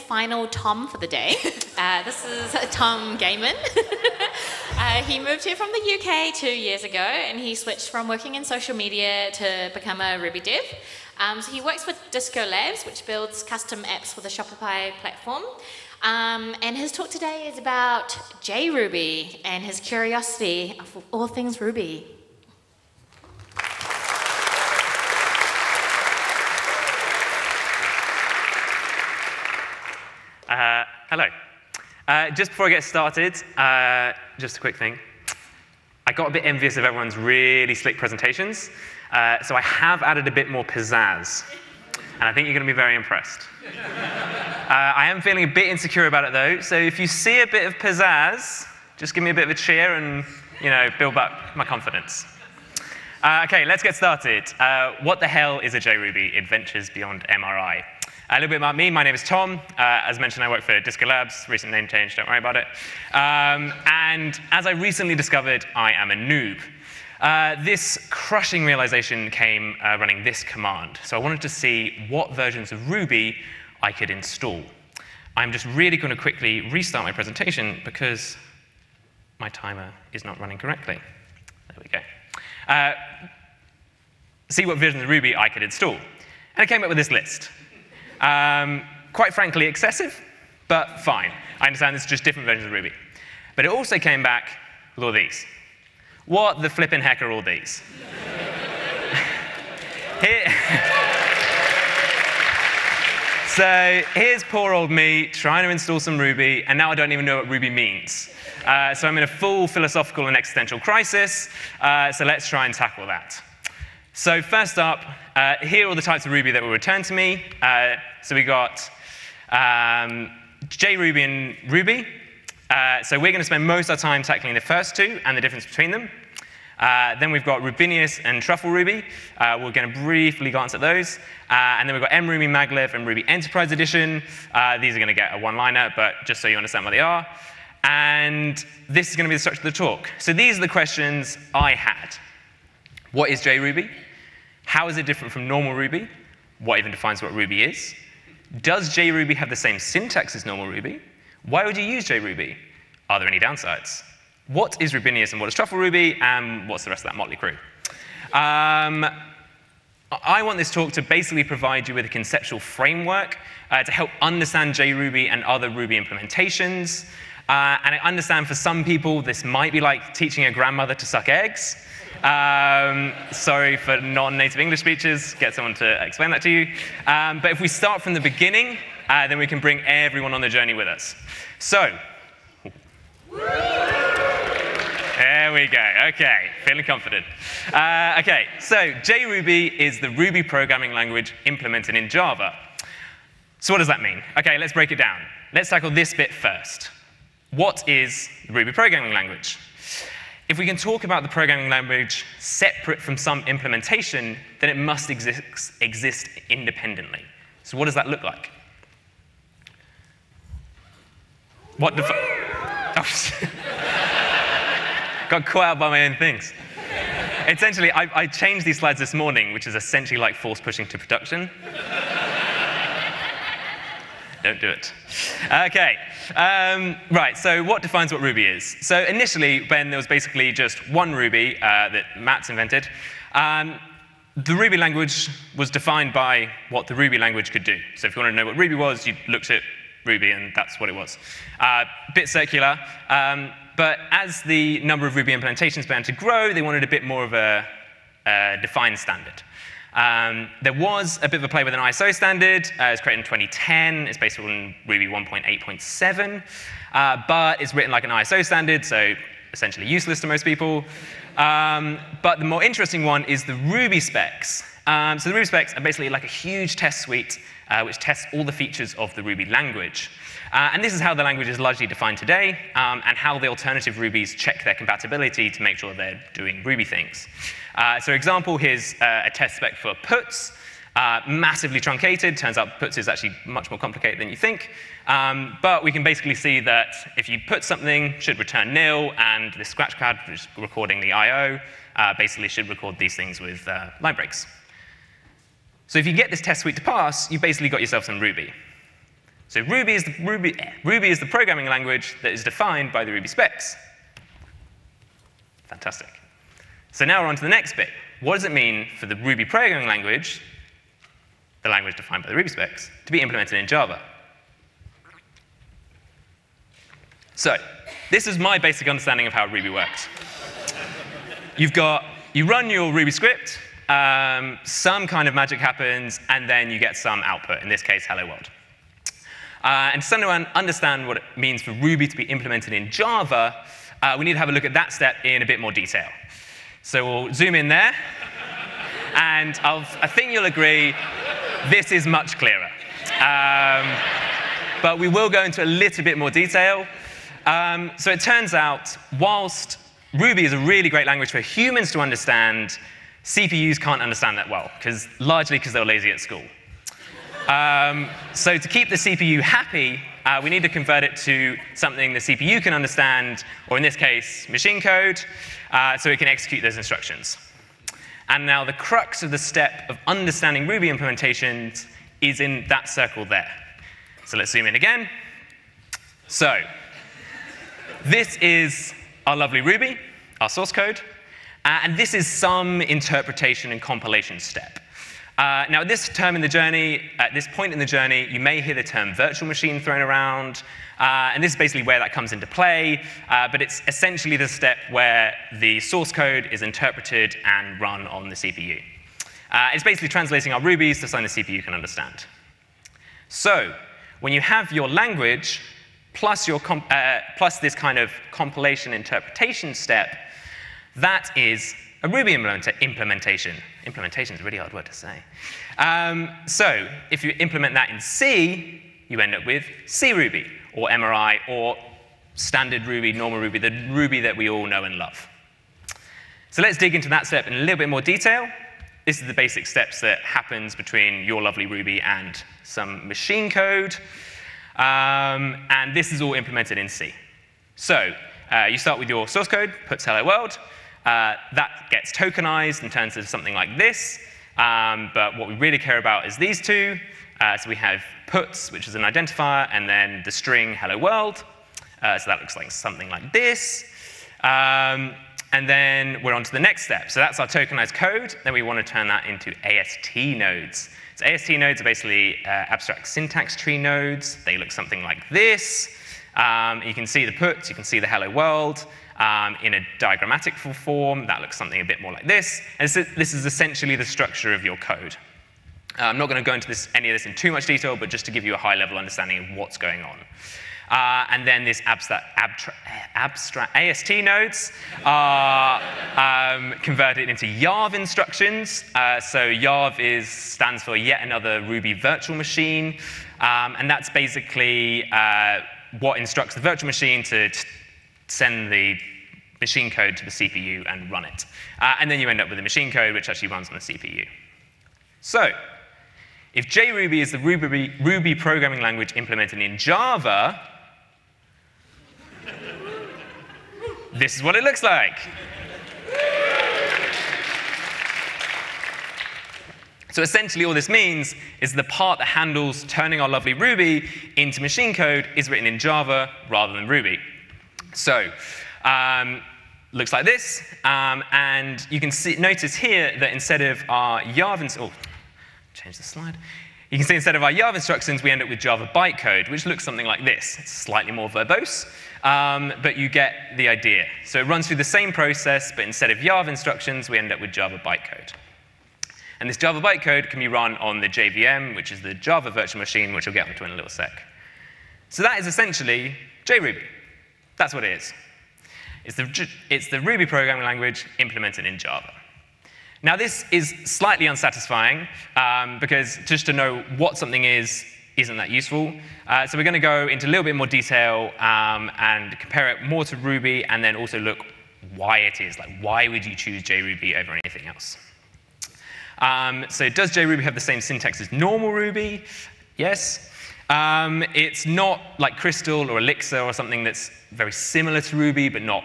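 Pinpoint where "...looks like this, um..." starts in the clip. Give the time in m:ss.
8:49.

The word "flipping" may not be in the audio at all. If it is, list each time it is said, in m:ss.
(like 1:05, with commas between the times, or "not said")
1:36.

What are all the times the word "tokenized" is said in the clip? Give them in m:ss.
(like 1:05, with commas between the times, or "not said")
7:22, 7:37.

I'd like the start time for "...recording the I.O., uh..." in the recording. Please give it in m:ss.
4:50.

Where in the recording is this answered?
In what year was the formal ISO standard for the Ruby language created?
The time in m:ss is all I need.
4:13.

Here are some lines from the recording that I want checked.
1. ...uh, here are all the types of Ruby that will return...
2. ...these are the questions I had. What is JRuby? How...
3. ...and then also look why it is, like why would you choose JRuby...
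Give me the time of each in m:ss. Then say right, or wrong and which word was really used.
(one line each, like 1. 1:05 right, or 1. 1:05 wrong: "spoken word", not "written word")
1. 1:55 right
2. 2:20 right
3. 9:33 right.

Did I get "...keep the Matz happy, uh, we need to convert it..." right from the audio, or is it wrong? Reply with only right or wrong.
wrong.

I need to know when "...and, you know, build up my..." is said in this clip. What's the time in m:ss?
0:49.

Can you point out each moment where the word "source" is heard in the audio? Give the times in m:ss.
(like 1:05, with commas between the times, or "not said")
6:20, 6:35, 7:19.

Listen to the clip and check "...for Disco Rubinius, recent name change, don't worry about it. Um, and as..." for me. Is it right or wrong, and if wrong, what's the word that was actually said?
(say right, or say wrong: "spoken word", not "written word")
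wrong: "Labs", not "Rubinius".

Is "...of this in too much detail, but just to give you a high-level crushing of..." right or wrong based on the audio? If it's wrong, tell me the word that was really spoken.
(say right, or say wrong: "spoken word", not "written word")
wrong: "understanding", not "crushing".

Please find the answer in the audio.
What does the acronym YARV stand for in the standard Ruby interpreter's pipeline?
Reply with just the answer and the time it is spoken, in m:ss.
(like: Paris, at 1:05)
Yet Another Ruby Virtual Machine, at 8:10.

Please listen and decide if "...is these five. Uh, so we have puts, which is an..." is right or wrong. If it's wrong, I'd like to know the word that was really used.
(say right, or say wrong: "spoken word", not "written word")
wrong: "two", not "five".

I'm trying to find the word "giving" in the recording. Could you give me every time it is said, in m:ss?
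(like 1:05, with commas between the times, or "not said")
not said.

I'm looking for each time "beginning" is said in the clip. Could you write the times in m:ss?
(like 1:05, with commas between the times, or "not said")
2:58.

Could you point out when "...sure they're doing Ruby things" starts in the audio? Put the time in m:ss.
4:35.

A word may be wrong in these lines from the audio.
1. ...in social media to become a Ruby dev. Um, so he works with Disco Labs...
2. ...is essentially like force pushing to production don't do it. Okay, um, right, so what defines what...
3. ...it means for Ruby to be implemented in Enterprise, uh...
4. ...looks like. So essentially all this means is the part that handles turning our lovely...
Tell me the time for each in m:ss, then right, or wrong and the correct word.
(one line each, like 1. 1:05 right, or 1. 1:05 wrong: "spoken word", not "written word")
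1. 0:08 right
2. 3:39 right
3. 5:31 wrong: "Java", not "Enterprise"
4. 8:34 right.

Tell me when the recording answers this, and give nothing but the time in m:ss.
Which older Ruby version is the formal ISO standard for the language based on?
4:14.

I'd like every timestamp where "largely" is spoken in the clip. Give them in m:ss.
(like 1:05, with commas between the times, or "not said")
4:31, 5:55.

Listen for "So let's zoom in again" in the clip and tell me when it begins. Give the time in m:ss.
6:14.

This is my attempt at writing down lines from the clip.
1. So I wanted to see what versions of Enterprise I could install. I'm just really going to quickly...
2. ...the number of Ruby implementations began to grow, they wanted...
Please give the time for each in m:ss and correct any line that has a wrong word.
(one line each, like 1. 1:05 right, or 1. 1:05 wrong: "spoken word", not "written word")
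1. 1:11 wrong: "Ruby", not "Enterprise"
2. 4:04 right.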